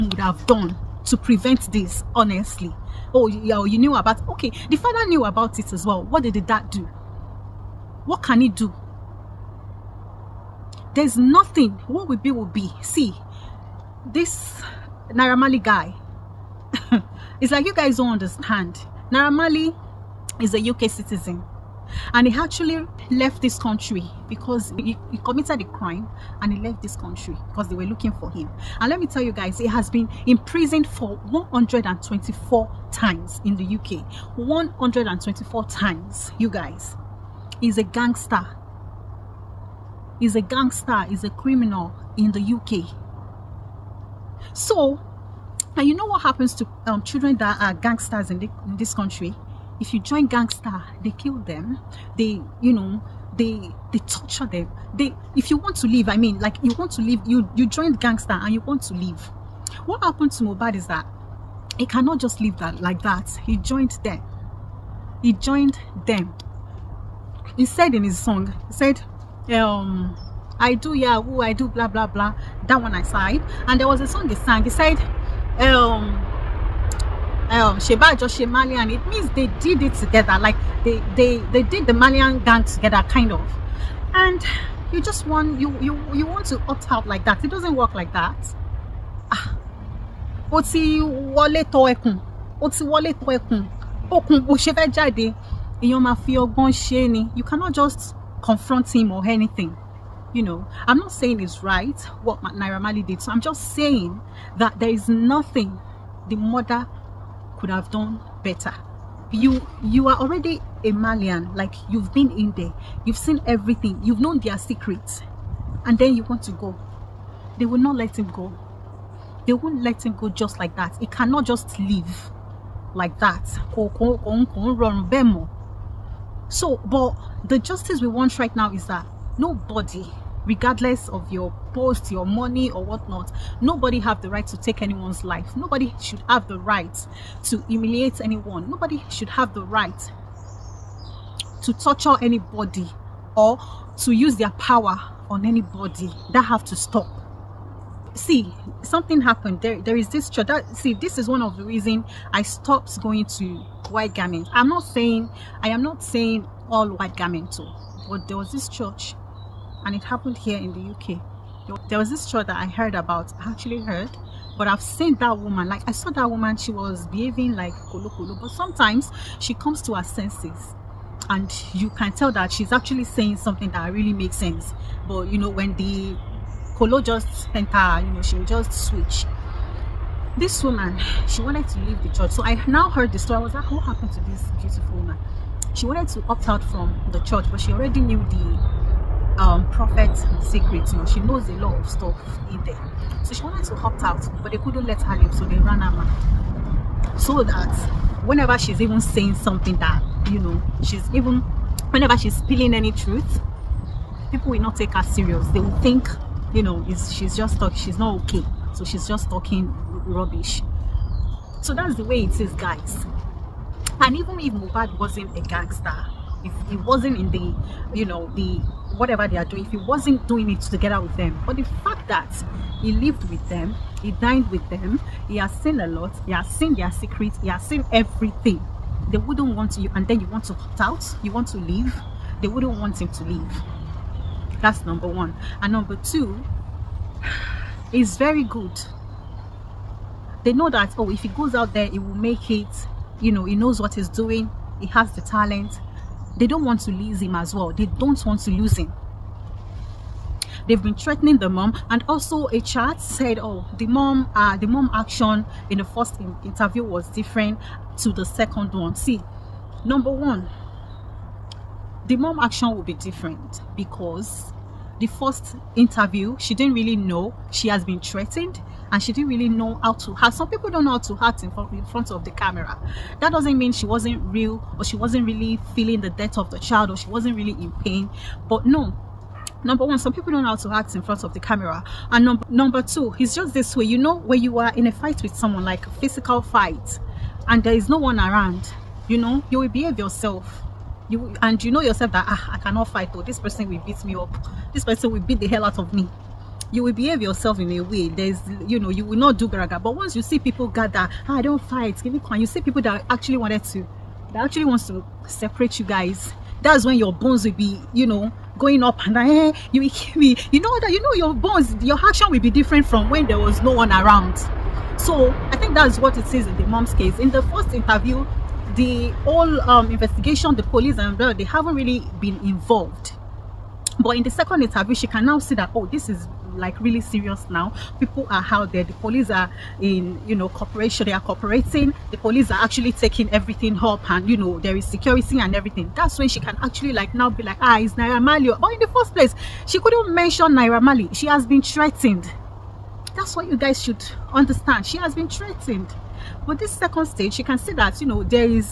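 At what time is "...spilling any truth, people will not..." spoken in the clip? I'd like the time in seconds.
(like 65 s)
202 s.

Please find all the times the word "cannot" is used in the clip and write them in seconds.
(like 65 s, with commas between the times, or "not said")
61 s, 97 s, 121 s, 292 s.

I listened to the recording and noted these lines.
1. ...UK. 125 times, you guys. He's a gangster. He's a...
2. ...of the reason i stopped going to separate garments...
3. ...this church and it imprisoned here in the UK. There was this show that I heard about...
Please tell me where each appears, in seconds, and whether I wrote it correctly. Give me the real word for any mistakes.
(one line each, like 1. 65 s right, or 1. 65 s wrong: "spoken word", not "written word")
1. 33 s wrong: "124", not "125"
2. 151 s wrong: "white", not "separate"
3. 158 s wrong: "happened", not "imprisoned".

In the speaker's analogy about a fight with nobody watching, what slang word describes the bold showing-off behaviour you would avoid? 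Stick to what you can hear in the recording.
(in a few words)
graga.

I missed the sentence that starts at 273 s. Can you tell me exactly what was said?
That doesn't mean she wasn't real or she wasn't really feeling the death of the child or she wasn't really in pain.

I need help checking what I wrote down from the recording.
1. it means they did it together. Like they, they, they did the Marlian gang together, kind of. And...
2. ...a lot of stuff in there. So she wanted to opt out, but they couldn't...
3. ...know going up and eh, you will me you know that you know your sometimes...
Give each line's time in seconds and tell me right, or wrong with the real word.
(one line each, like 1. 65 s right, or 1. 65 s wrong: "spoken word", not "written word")
1. 78 s right
2. 191 s right
3. 308 s wrong: "bones", not "sometimes".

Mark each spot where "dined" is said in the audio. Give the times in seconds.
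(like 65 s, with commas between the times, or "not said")
224 s.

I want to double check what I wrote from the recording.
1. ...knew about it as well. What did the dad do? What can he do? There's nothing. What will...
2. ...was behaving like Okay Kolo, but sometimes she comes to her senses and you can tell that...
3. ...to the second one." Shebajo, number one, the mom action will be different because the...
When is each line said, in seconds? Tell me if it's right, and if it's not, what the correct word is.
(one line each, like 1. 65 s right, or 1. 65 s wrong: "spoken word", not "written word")
1. 5 s right
2. 166 s wrong: "Kolo", not "Okay"
3. 257 s wrong: "See", not "Shebajo".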